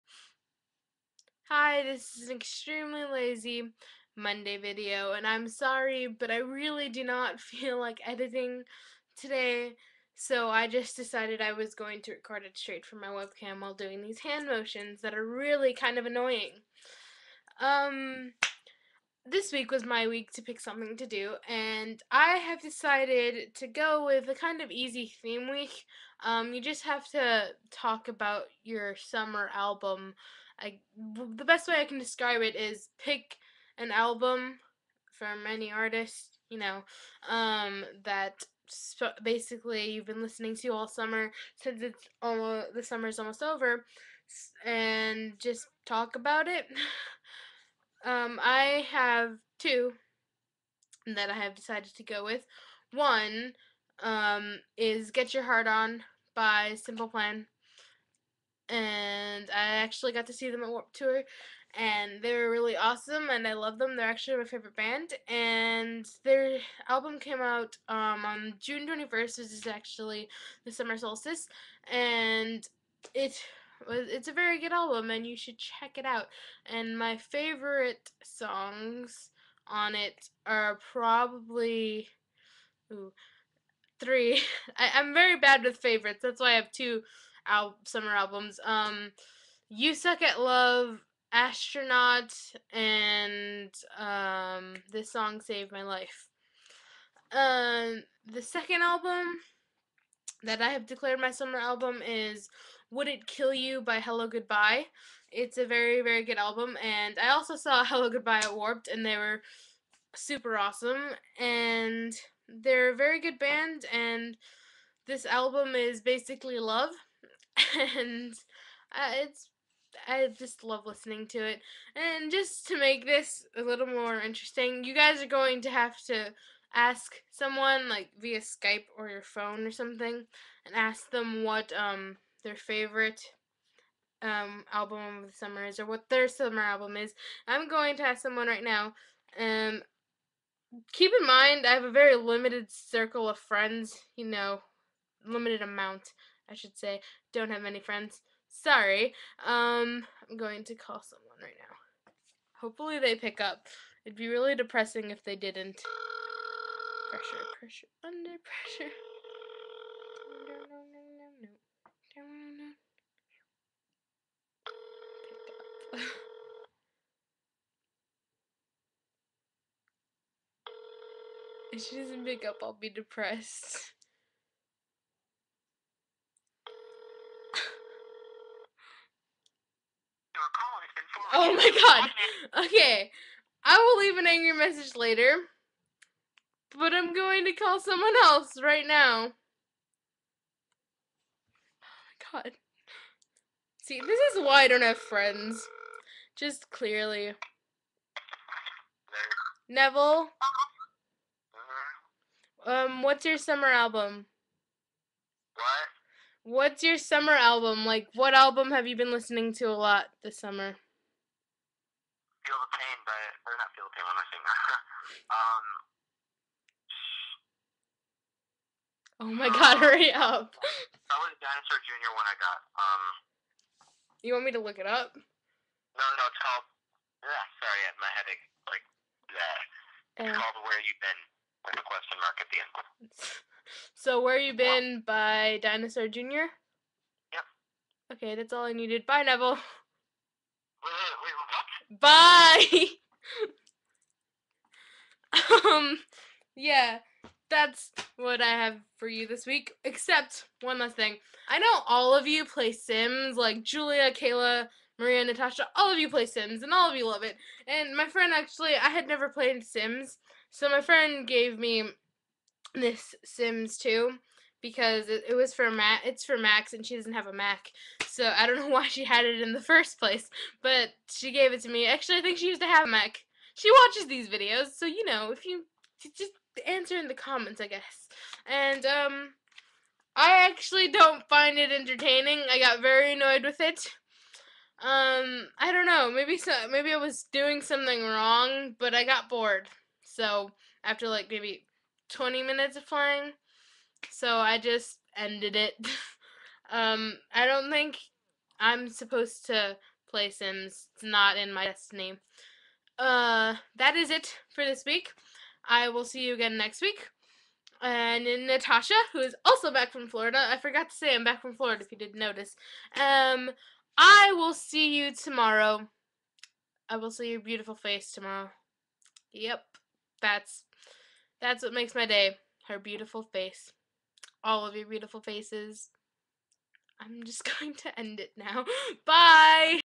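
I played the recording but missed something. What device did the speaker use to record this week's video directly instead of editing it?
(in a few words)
webcam.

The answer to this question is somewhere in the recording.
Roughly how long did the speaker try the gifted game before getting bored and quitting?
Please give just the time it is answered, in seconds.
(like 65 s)
292 s.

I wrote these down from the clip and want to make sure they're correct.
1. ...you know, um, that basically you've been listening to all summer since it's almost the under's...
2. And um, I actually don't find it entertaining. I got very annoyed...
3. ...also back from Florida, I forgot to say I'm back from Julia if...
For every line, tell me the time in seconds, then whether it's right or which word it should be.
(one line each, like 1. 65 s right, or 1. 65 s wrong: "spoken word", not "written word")
1. 36 s wrong: "summer", not "under"
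2. 278 s right
3. 309 s wrong: "Florida", not "Julia".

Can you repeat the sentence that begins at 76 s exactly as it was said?
And my favorite songs on it are probably.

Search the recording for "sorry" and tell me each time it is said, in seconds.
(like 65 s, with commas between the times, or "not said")
5 s, 148 s, 227 s.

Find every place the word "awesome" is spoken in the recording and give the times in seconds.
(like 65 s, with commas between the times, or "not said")
62 s, 110 s.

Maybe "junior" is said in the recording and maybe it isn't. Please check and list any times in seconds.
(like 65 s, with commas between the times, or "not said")
221 s, 236 s.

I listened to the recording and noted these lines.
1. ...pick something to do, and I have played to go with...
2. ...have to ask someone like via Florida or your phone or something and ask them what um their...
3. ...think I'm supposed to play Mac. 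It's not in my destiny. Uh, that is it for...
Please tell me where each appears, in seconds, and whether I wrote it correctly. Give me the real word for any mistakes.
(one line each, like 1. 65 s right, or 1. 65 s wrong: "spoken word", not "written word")
1. 20 s wrong: "decided", not "played"
2. 125 s wrong: "Skype", not "Florida"
3. 297 s wrong: "Sims", not "Mac".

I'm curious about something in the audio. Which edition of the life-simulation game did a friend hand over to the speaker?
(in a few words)
Sims 2.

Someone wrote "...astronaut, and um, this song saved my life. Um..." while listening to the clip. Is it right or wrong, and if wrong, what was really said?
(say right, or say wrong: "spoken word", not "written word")
right.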